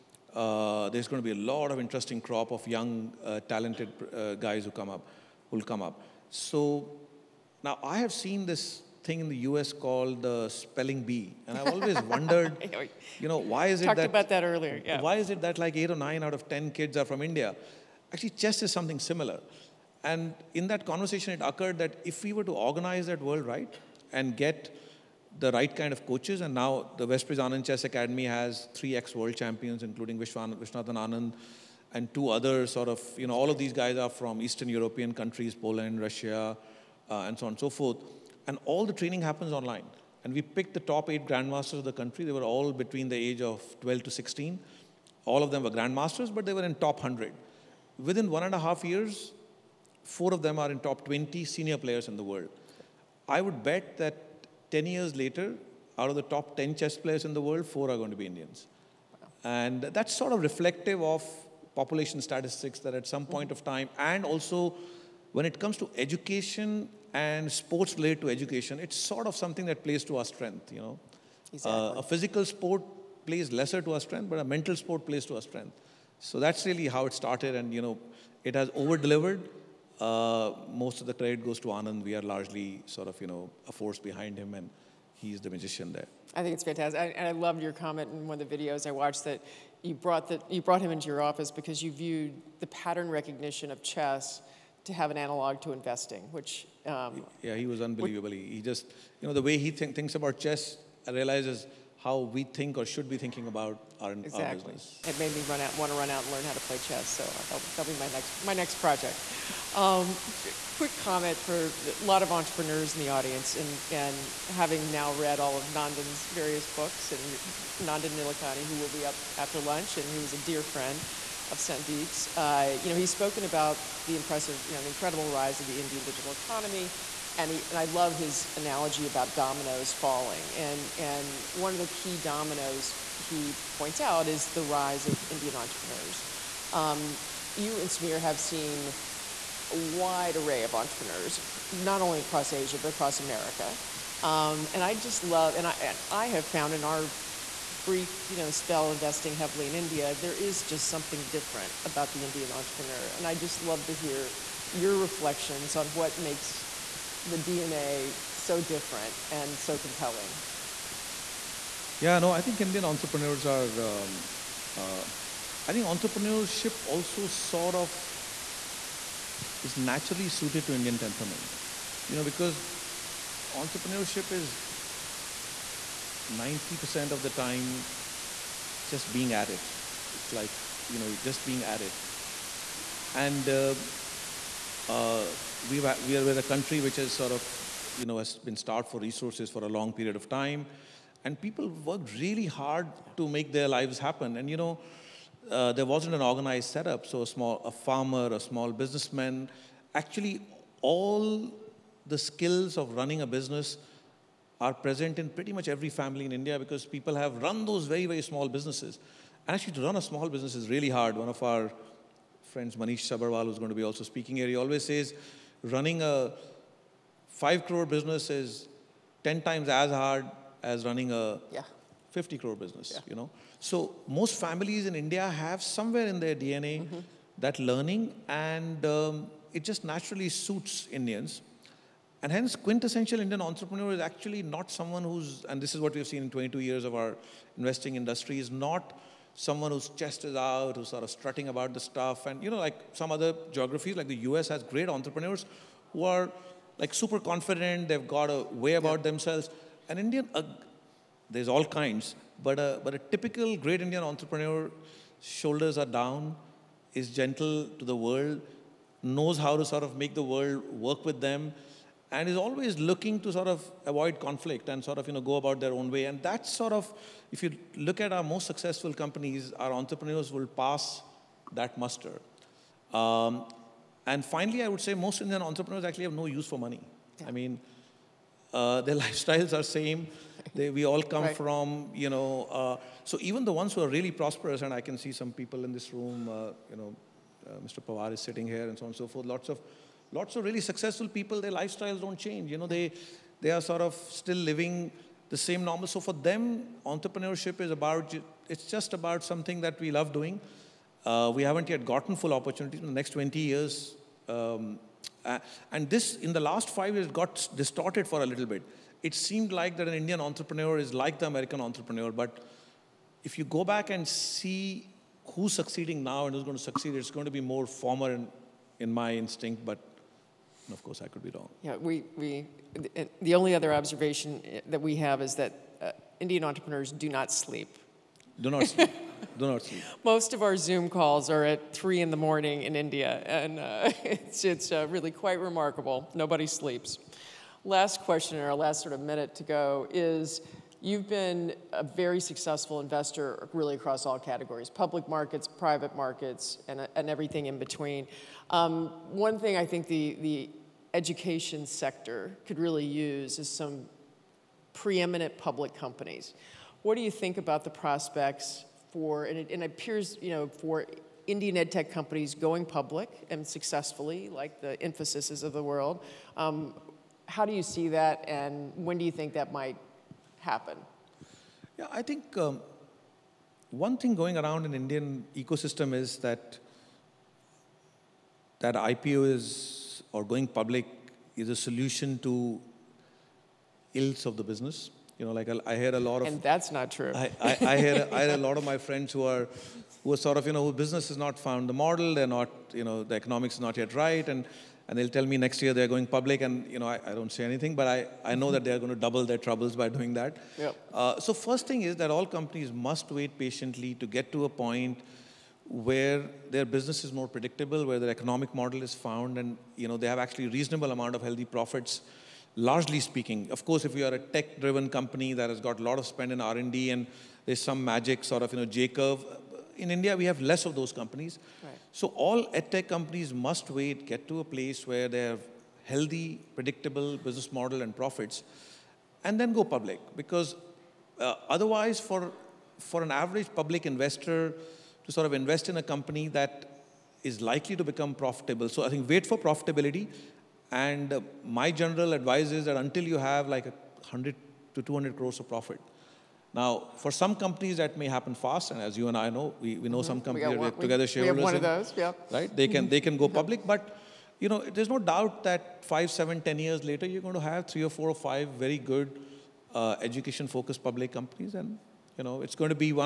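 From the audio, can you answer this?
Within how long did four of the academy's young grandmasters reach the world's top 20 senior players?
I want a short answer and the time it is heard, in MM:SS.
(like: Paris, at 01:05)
1.5 years, at 00:48.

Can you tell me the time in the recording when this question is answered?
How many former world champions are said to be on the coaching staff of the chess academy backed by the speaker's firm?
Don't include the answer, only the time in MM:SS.
00:28.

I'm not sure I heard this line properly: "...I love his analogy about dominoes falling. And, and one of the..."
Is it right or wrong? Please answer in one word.
right.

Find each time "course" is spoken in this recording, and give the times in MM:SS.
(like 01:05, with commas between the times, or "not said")
05:20, 06:53.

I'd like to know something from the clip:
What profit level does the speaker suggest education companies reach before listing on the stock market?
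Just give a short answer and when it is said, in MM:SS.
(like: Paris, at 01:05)
100 to 200 crores, at 07:23.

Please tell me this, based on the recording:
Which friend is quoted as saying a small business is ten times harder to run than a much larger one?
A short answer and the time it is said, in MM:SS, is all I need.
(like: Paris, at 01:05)
Manish Sabharwal, at 03:32.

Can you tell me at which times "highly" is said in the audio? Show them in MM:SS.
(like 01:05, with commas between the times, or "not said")
not said.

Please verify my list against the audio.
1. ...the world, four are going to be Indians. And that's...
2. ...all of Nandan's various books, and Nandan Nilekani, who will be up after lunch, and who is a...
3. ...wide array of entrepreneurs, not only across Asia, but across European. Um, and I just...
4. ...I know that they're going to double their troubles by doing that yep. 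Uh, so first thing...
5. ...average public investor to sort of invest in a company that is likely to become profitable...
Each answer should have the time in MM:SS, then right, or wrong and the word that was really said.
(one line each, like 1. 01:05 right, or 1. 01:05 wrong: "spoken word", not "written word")
1. 00:57 right
2. 01:55 right
3. 02:19 wrong: "America", not "European"
4. 06:38 right
5. 07:13 right.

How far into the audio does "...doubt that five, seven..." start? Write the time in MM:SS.
07:35.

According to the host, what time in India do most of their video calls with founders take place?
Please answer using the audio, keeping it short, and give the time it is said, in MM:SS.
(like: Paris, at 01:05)
3 a.m., at 05:31.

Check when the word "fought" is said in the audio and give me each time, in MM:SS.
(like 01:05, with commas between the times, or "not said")
not said.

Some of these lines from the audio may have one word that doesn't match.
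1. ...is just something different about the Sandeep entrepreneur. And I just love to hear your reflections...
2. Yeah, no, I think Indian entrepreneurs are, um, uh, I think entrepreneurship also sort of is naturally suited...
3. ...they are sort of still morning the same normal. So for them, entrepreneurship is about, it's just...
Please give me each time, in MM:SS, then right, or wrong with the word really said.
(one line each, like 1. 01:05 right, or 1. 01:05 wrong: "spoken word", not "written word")
1. 02:30 wrong: "Indian", not "Sandeep"
2. 02:42 right
3. 04:53 wrong: "living", not "morning".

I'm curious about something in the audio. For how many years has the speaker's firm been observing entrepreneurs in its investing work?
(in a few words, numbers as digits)
22.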